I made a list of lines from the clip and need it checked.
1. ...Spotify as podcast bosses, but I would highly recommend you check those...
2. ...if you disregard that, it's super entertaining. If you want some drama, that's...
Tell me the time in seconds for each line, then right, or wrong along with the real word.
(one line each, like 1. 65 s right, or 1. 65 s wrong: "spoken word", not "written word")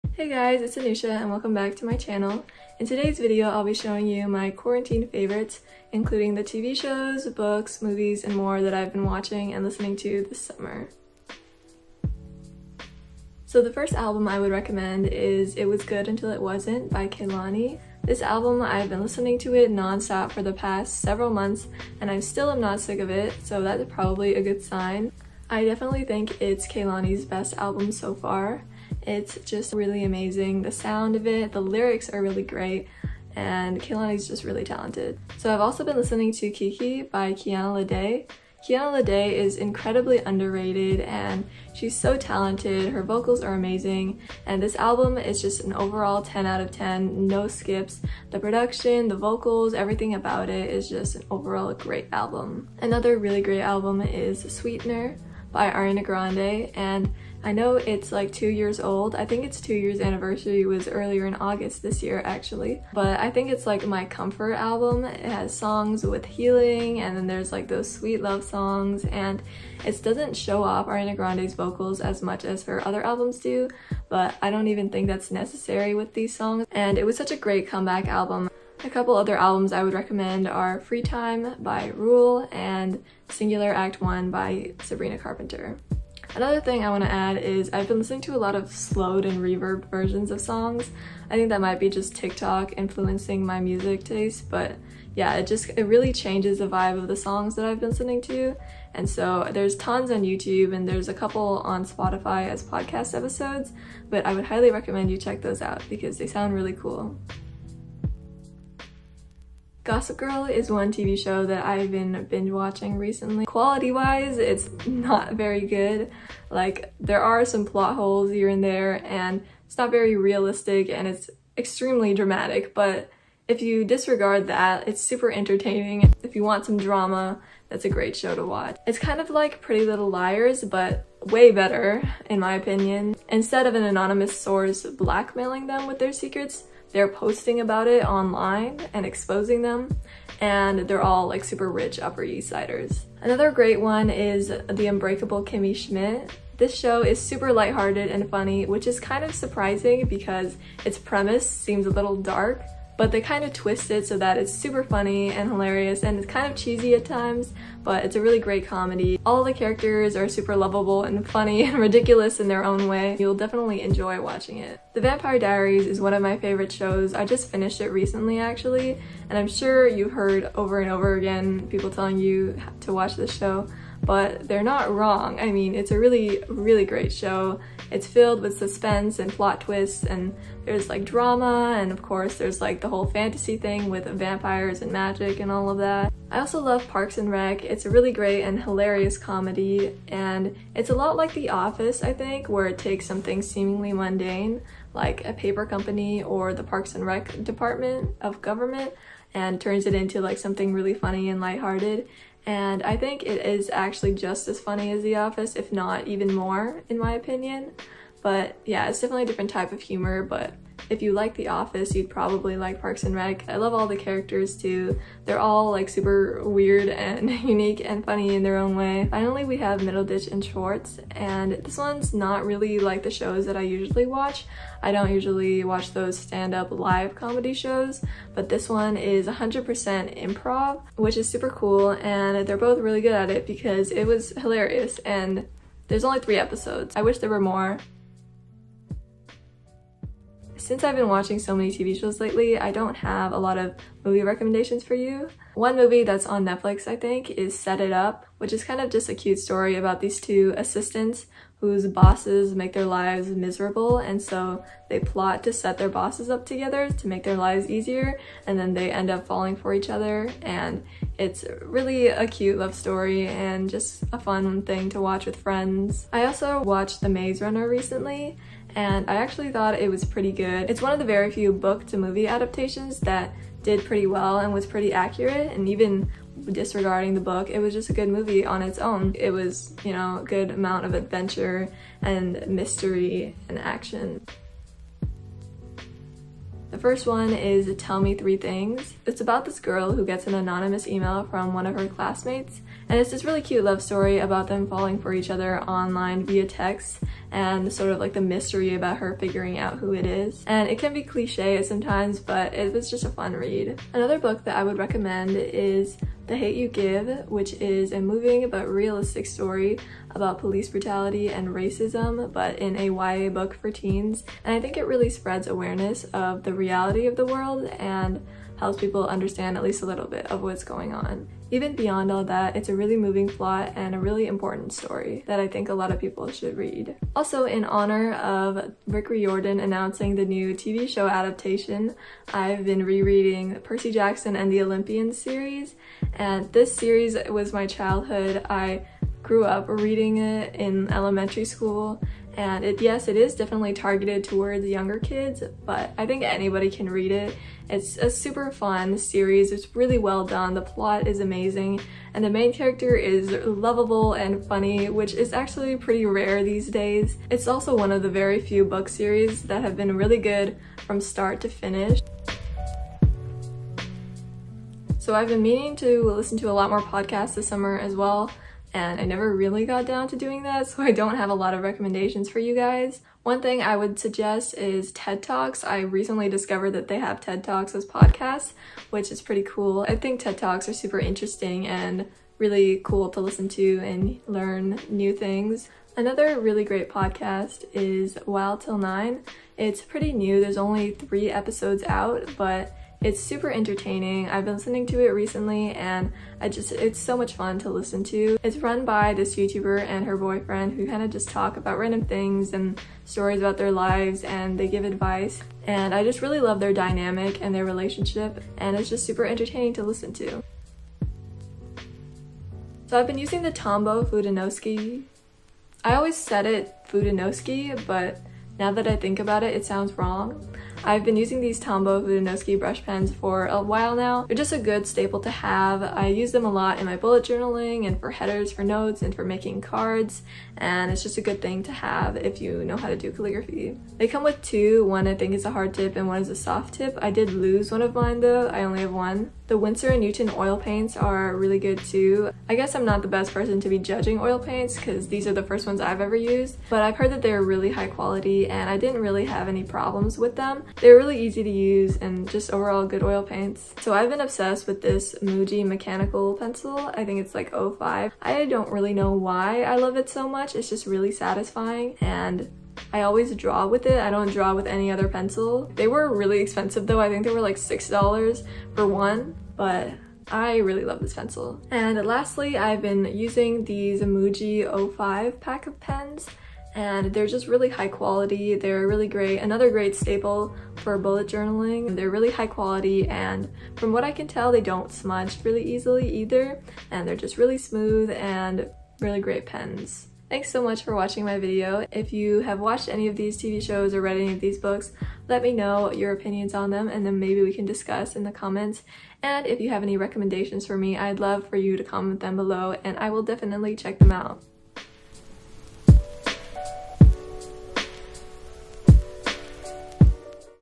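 1. 101 s wrong: "episodes", not "bosses"
2. 123 s right.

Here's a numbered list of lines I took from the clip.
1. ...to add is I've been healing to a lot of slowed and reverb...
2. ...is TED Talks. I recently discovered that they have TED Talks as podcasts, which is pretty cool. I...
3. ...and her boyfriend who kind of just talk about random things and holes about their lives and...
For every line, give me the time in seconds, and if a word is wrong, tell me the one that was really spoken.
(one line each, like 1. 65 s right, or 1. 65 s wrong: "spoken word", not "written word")
1. 87 s wrong: "listening", not "healing"
2. 374 s right
3. 399 s wrong: "stories", not "holes".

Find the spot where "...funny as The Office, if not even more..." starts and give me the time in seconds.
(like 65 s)
204 s.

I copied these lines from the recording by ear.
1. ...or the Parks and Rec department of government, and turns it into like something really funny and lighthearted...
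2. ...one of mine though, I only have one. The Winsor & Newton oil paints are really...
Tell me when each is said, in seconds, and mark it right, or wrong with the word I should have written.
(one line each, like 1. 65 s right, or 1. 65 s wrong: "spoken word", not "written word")
1. 196 s right
2. 437 s right.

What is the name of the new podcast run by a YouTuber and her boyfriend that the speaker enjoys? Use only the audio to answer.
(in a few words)
Wild Till Nine.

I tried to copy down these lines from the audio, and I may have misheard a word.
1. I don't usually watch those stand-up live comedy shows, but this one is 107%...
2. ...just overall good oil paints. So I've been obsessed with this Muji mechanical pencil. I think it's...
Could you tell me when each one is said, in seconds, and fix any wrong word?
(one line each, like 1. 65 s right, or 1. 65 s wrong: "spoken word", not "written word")
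1. 224 s wrong: "100", not "107"
2. 452 s right.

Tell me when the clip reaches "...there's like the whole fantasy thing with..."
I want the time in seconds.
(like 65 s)
182 s.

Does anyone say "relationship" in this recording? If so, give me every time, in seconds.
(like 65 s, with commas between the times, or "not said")
407 s.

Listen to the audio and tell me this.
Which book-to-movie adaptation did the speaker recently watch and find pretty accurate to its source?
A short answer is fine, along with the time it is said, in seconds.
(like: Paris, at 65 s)
The Maze Runner, at 267 s.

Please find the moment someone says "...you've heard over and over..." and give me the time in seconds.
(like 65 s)
169 s.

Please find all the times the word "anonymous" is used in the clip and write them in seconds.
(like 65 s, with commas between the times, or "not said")
133 s, 290 s.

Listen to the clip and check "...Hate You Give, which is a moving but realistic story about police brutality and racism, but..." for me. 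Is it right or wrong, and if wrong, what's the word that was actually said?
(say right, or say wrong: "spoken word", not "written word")
right.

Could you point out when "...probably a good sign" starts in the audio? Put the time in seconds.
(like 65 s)
23 s.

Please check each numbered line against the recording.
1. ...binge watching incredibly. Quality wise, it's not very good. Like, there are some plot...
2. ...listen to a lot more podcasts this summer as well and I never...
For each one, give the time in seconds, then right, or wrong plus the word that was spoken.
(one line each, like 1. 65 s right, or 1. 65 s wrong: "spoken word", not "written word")
1. 112 s wrong: "recently", not "incredibly"
2. 366 s right.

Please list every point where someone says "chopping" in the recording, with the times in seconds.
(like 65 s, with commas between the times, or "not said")
not said.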